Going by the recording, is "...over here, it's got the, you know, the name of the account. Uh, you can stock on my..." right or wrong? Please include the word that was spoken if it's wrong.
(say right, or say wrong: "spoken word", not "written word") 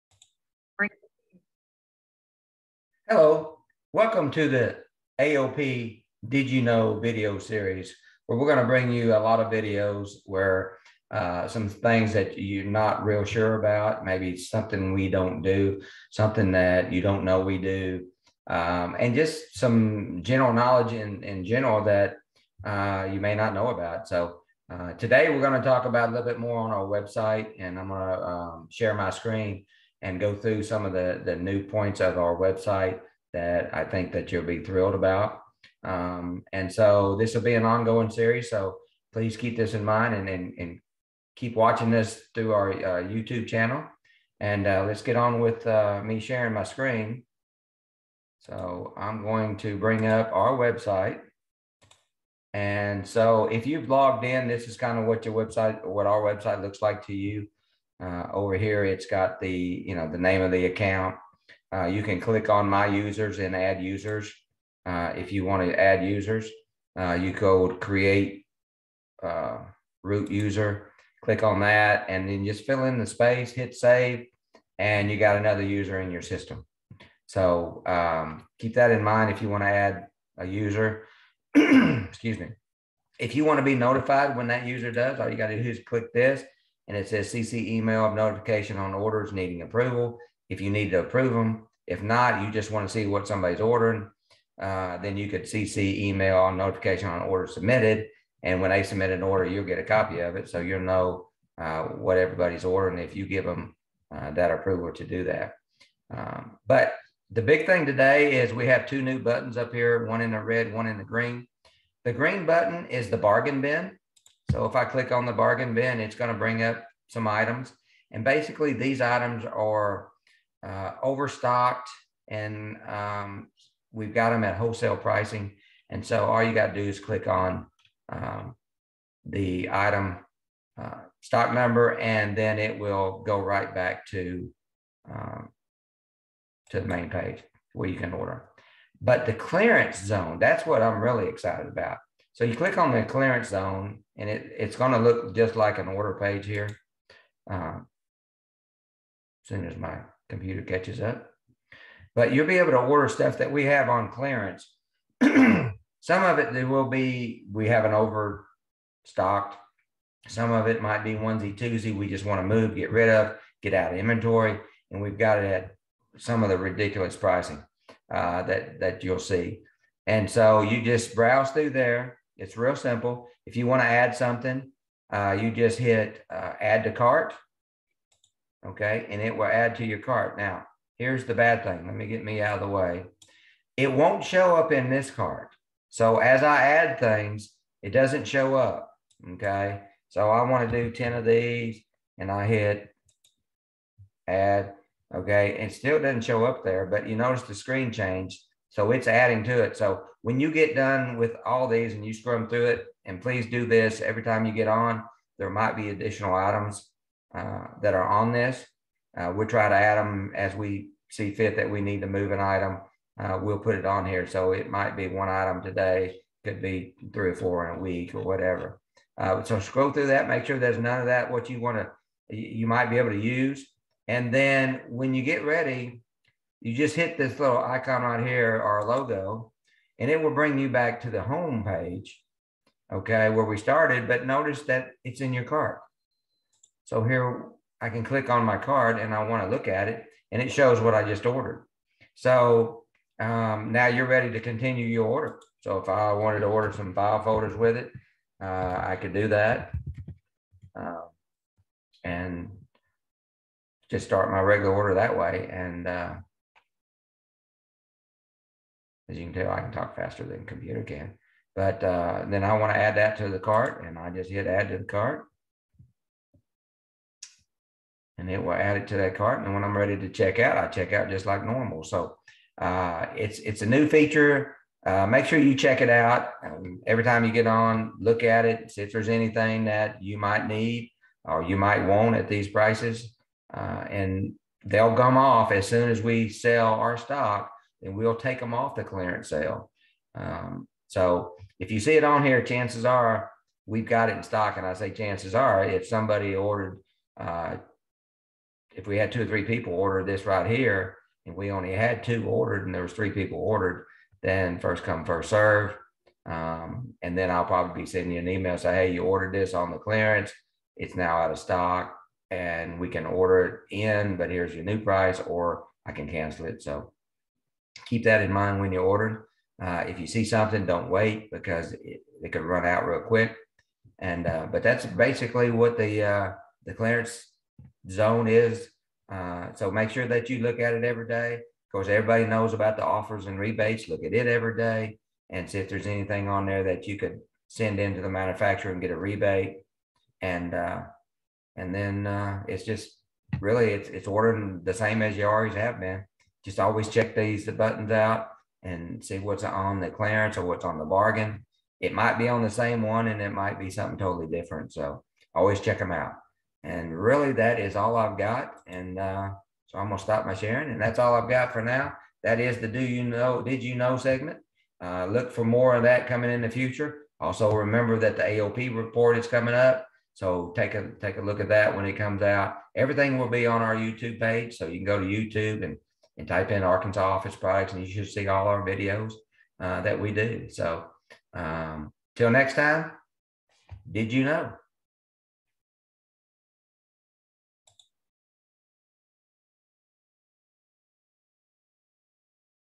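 wrong: "click", not "stock".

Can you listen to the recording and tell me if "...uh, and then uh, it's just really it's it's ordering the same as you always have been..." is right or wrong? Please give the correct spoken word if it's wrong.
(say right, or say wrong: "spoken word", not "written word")
right.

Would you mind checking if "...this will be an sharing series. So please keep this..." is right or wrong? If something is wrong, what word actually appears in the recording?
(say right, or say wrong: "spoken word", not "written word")
wrong: "ongoing", not "sharing".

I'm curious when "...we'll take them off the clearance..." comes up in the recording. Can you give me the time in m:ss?
4:47.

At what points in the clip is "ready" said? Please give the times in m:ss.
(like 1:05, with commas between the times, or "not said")
3:45, 4:04, 4:29.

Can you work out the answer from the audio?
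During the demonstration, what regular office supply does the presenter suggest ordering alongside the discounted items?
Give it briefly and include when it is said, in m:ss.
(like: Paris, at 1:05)
File folders, at 4:06.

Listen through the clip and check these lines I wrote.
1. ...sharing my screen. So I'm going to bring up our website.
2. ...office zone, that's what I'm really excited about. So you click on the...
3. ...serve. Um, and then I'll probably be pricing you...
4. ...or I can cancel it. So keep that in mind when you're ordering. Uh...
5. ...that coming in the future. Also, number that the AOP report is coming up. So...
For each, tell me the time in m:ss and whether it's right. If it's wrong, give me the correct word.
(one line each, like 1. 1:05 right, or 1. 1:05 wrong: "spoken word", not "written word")
1. 0:46 right
2. 2:19 wrong: "clearance", not "office"
3. 5:05 wrong: "sending", not "pricing"
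4. 5:15 right
5. 6:05 wrong: "remember", not "number".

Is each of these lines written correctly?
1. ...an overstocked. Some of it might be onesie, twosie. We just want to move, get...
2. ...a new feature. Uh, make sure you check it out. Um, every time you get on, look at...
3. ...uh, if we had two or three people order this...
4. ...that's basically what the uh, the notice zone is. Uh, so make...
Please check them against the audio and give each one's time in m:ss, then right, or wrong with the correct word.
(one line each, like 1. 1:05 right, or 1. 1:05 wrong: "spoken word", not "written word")
1. 2:37 right
2. 4:33 right
3. 4:57 right
4. 5:24 wrong: "clearance", not "notice".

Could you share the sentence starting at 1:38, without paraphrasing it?
And when they submit an order, you'll get a copy of it.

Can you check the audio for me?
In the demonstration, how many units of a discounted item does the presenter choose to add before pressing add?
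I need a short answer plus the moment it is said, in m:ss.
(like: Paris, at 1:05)
10, at 3:10.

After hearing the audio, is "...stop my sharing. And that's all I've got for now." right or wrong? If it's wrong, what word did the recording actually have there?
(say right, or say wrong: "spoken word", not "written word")
right.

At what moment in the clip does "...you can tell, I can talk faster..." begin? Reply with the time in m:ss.
4:19.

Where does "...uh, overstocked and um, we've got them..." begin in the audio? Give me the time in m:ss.
2:00.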